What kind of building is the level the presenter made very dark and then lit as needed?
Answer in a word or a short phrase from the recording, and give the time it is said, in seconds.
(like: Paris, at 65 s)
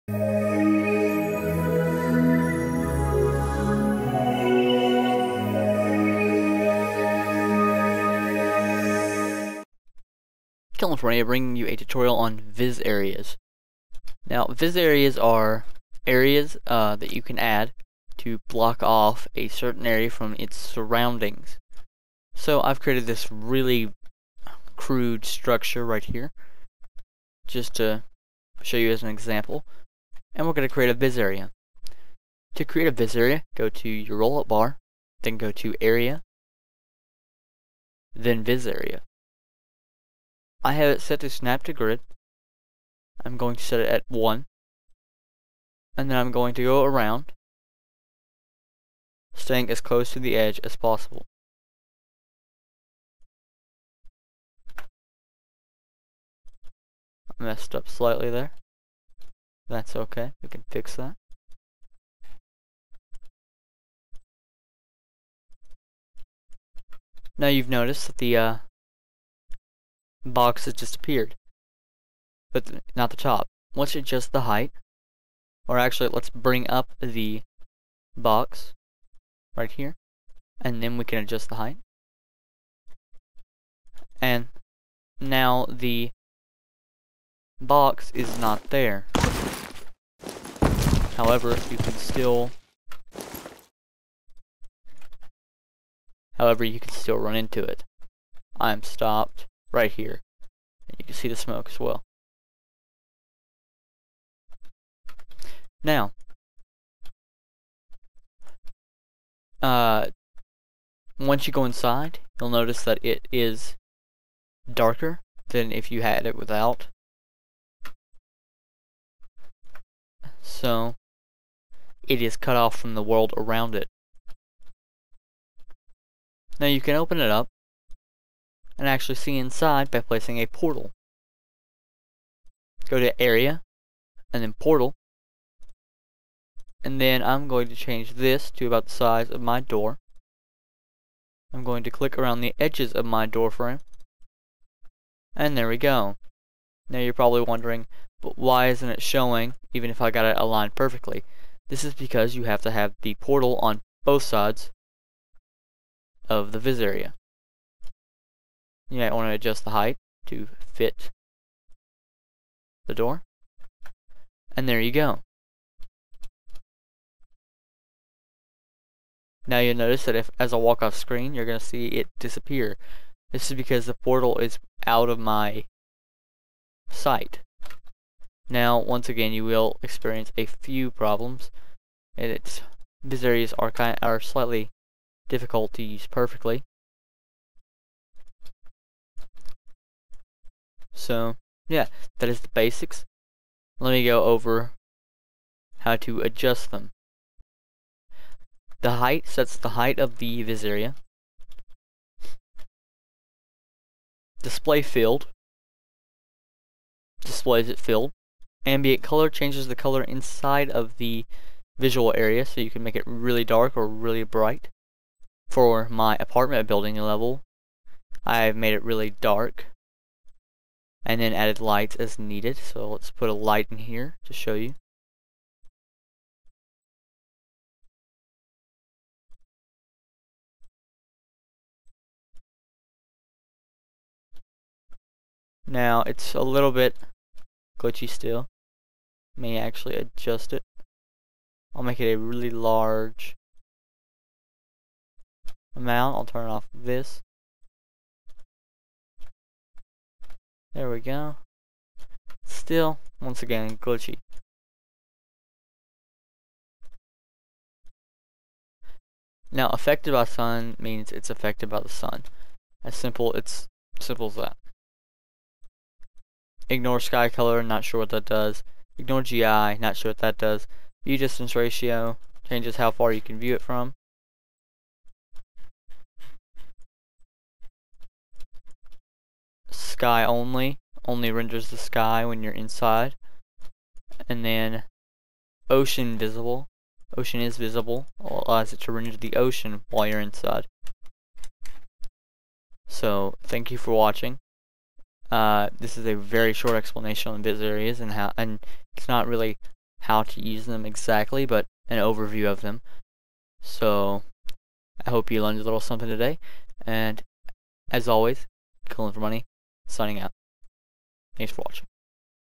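apartment building, at 216 s.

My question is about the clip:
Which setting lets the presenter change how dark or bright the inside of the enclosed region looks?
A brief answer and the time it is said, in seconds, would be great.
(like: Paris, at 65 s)
Ambient color, at 208 s.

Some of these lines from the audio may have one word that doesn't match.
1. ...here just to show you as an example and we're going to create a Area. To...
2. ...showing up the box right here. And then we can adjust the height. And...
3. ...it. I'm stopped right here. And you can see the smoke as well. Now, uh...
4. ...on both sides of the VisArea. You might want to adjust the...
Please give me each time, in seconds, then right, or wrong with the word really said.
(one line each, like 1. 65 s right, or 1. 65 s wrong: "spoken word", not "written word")
1. 26 s wrong: "VisArea", not "Area"
2. 76 s wrong: "bring", not "showing"
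3. 97 s right
4. 153 s right.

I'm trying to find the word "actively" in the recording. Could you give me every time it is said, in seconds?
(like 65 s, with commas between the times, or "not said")
not said.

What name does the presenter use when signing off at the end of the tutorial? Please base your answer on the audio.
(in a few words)
killing for money.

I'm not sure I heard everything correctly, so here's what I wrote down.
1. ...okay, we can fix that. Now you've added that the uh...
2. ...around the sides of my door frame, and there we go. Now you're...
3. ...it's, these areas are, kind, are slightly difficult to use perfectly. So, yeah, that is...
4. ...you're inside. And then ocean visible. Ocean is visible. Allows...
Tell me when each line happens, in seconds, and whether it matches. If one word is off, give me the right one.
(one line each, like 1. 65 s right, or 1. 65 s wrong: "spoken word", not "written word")
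1. 59 s wrong: "noticed", not "added"
2. 142 s wrong: "edges", not "sides"
3. 182 s right
4. 282 s right.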